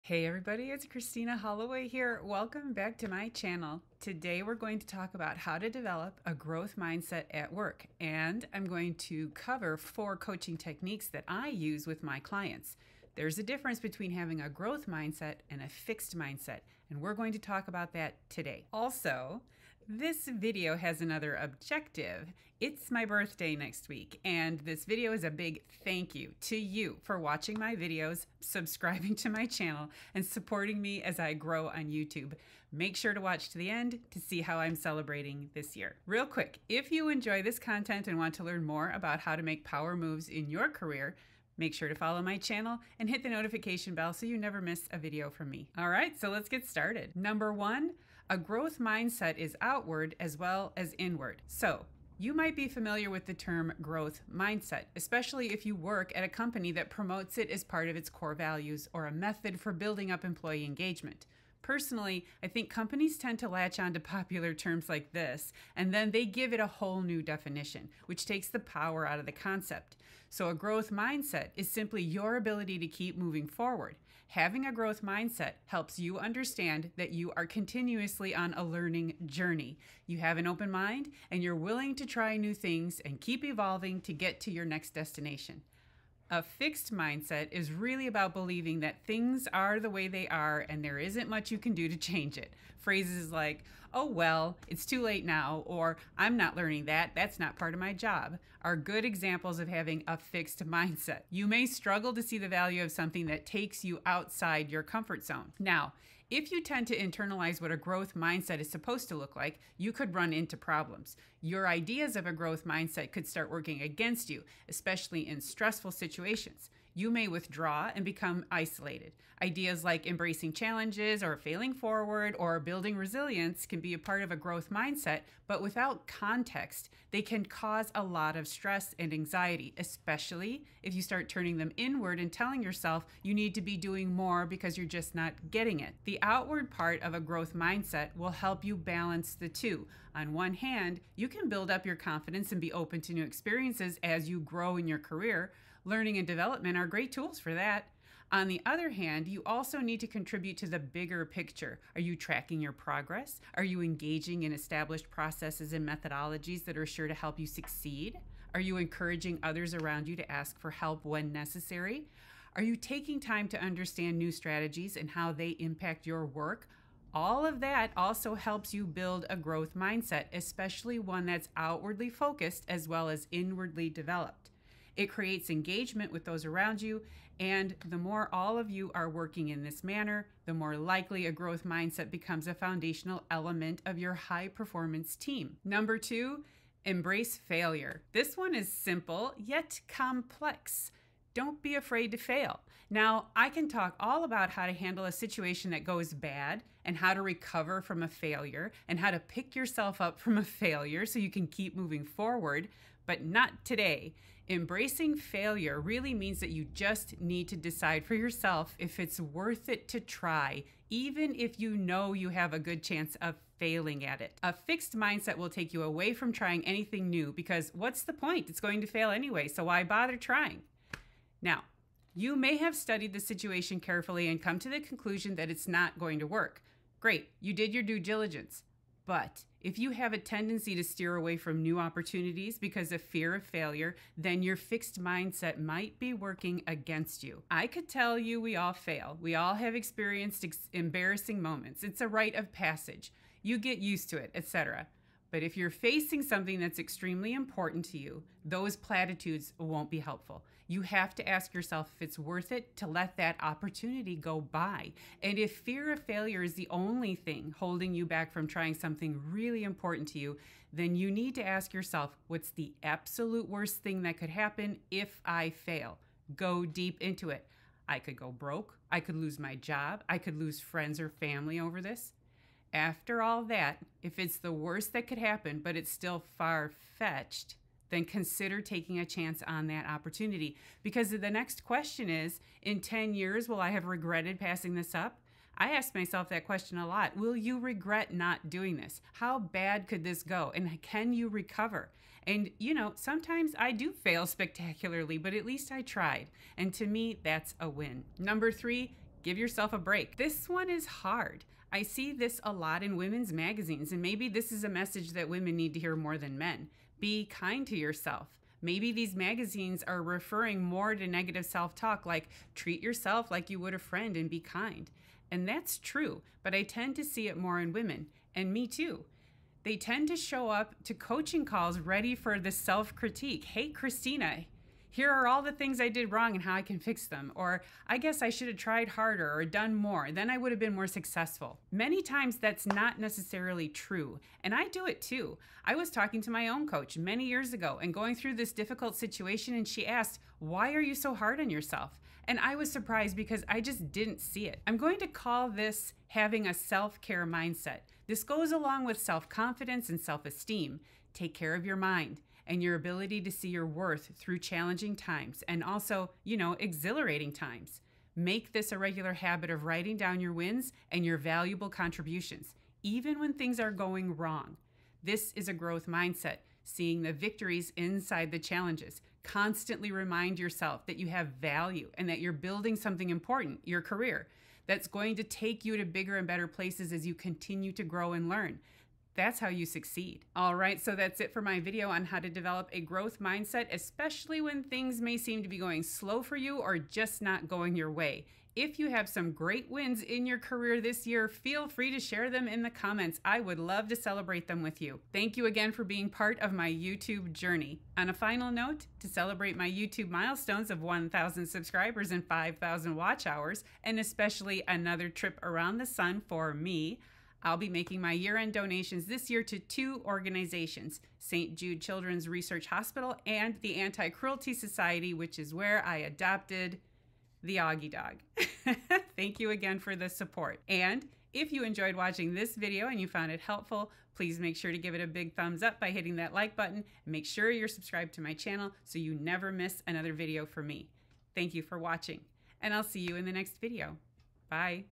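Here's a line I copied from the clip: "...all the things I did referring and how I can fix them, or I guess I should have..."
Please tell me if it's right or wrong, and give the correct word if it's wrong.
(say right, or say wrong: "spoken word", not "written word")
wrong: "wrong", not "referring".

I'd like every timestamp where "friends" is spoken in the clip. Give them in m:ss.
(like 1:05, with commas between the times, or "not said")
4:30, 5:13.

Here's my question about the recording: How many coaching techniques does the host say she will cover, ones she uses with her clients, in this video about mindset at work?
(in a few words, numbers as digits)
4.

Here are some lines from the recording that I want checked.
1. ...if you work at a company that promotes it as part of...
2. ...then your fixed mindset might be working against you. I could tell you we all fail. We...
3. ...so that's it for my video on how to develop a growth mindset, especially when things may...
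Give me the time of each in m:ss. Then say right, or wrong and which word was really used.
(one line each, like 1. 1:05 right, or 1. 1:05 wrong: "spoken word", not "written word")
1. 0:55 right
2. 3:54 right
3. 6:20 right.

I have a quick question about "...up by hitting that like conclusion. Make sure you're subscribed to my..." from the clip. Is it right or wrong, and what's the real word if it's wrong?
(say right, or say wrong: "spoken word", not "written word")
wrong: "button", not "conclusion".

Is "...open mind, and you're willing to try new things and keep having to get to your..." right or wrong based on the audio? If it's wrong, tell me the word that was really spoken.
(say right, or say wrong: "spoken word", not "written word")
wrong: "evolving", not "having".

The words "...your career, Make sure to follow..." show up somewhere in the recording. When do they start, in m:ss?
0:40.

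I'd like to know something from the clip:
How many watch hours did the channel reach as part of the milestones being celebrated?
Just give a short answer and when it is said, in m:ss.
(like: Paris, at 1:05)
5,000, at 6:42.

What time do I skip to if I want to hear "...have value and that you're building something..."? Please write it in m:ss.
6:11.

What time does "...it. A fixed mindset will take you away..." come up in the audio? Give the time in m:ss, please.
3:34.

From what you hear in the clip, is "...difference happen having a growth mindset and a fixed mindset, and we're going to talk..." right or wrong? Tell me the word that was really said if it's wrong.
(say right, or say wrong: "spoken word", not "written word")
wrong: "between", not "happen".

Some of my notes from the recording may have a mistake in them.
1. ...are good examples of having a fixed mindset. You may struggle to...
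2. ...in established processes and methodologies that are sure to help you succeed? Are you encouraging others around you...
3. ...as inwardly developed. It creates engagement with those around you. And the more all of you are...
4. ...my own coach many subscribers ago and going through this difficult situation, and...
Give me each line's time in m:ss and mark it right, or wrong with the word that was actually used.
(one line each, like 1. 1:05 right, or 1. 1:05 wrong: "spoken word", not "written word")
1. 1:38 right
2. 2:34 right
3. 2:53 right
4. 5:36 wrong: "years", not "subscribers".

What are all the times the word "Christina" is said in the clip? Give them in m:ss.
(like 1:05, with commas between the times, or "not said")
0:00, 5:23.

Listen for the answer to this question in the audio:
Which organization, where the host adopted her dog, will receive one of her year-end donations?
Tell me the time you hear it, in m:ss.
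6:53.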